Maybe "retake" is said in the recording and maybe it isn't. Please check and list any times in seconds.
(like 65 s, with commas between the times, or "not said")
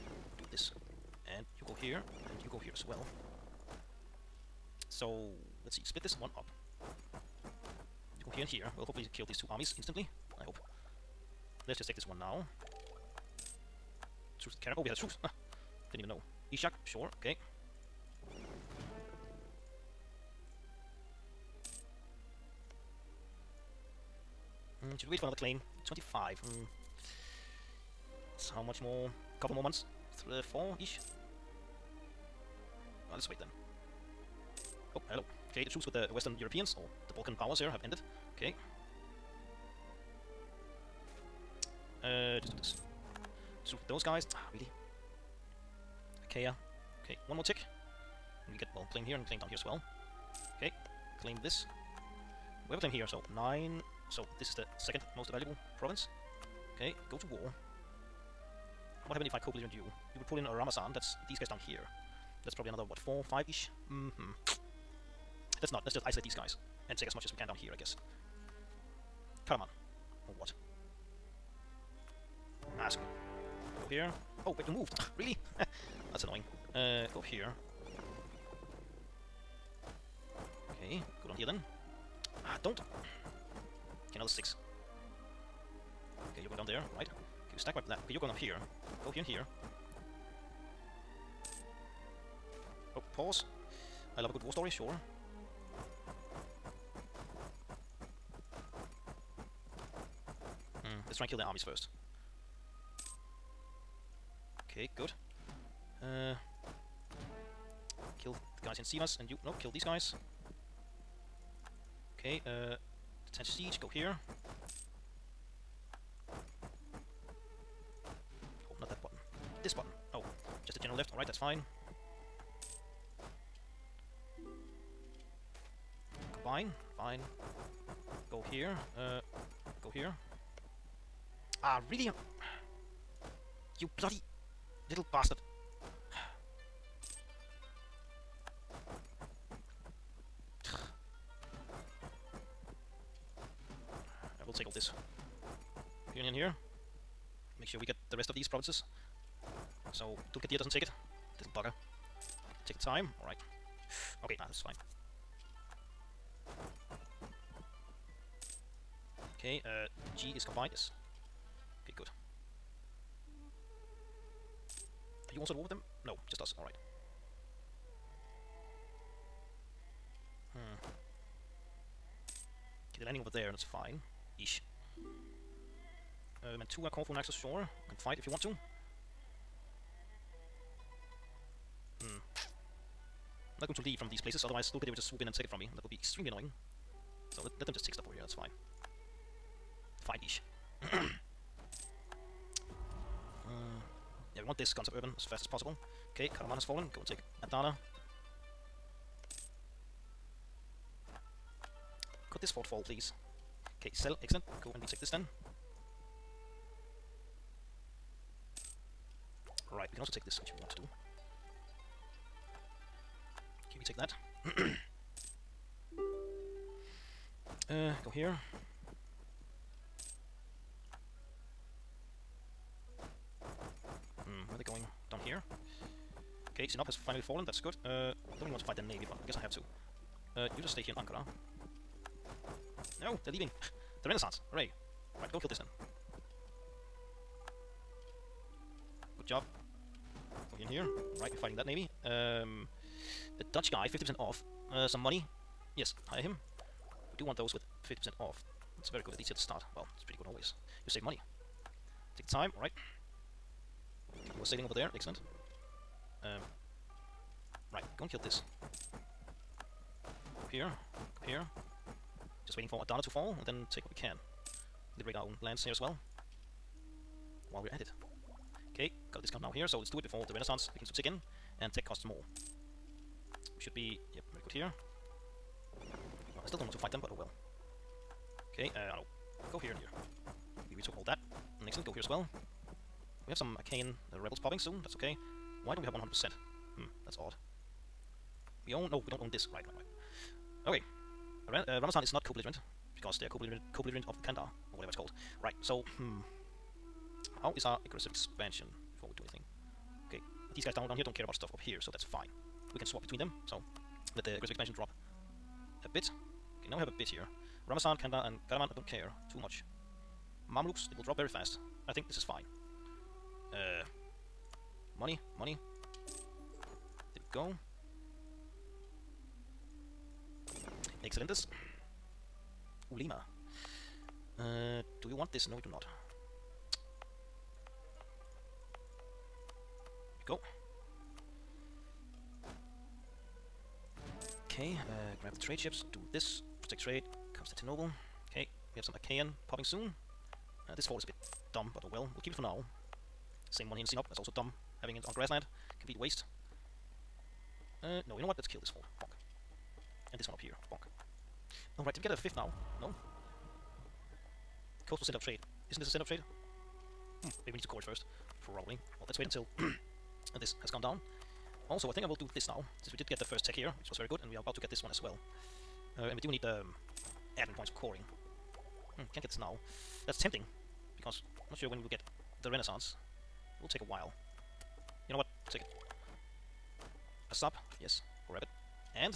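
204 s.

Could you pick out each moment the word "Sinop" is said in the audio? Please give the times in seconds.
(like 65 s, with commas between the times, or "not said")
226 s, 343 s.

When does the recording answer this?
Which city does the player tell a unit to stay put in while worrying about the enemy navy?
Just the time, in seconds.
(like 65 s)
230 s.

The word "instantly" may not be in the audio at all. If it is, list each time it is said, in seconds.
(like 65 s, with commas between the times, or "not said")
9 s.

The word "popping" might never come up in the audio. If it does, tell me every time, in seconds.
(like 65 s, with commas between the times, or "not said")
284 s, 339 s.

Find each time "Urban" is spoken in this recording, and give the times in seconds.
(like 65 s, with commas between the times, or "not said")
194 s.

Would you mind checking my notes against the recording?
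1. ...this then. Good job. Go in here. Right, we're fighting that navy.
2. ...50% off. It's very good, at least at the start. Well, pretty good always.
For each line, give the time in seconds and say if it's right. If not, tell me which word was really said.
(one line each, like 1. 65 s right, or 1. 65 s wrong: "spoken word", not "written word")
1. 235 s right
2. 247 s right.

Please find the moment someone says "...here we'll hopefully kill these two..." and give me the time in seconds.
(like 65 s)
8 s.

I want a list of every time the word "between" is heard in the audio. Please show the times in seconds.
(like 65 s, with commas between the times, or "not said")
303 s.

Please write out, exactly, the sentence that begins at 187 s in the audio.
So let, let them just take stuff over here, that's fine.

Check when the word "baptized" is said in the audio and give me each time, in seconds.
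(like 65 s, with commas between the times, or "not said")
not said.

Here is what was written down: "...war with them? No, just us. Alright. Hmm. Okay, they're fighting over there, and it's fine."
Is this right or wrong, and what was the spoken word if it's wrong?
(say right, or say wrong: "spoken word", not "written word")
wrong: "landing", not "fighting".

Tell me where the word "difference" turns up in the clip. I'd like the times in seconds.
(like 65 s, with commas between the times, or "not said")
not said.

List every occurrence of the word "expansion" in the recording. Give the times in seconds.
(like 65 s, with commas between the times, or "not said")
298 s, 304 s.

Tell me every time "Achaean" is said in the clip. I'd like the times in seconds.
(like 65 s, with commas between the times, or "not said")
283 s, 338 s.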